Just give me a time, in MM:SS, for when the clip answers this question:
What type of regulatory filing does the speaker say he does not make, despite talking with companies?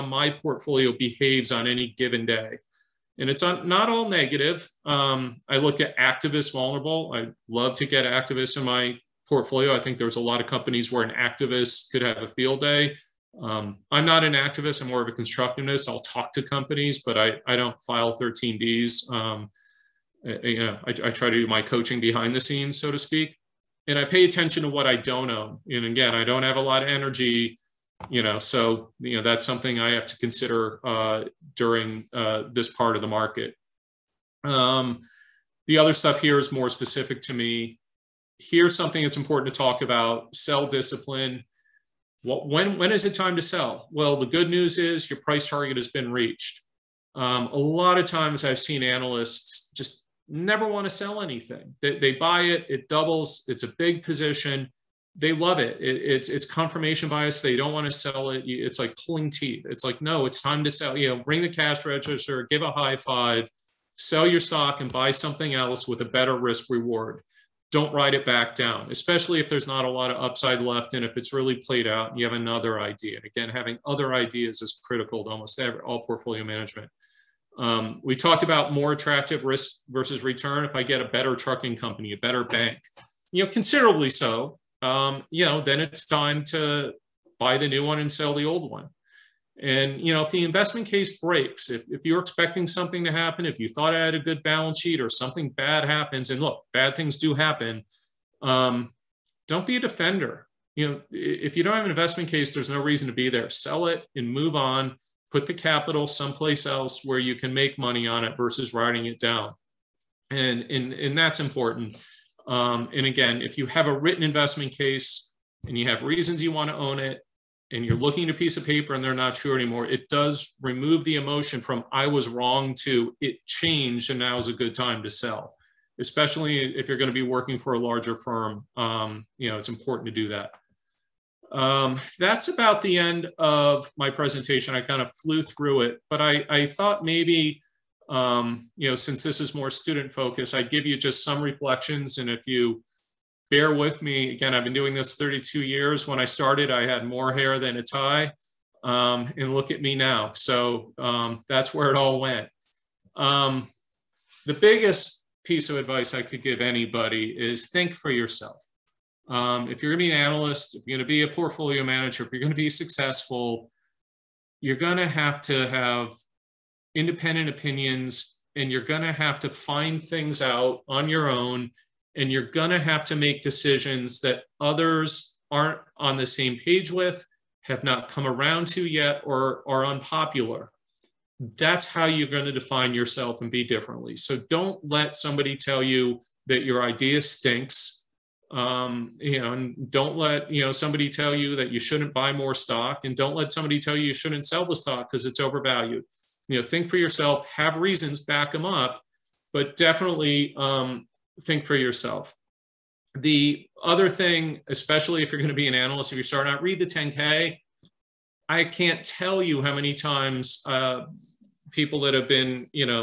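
00:18.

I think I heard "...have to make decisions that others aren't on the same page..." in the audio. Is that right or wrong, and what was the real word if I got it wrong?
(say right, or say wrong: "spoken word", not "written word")
right.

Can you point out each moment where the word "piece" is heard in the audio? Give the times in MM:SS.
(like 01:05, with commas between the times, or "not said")
01:58, 02:35.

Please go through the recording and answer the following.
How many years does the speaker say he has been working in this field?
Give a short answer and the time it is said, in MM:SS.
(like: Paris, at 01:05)
32 years, at 02:25.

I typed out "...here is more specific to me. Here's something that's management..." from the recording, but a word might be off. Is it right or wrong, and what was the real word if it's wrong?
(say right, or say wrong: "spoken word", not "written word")
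wrong: "important", not "management".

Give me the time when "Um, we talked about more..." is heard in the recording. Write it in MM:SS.
01:17.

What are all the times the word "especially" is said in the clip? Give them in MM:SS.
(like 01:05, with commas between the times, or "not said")
01:08, 02:05, 03:24.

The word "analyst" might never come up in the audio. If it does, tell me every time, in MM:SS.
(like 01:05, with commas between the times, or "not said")
00:48, 02:40, 03:25.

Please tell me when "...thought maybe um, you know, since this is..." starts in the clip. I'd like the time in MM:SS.
02:16.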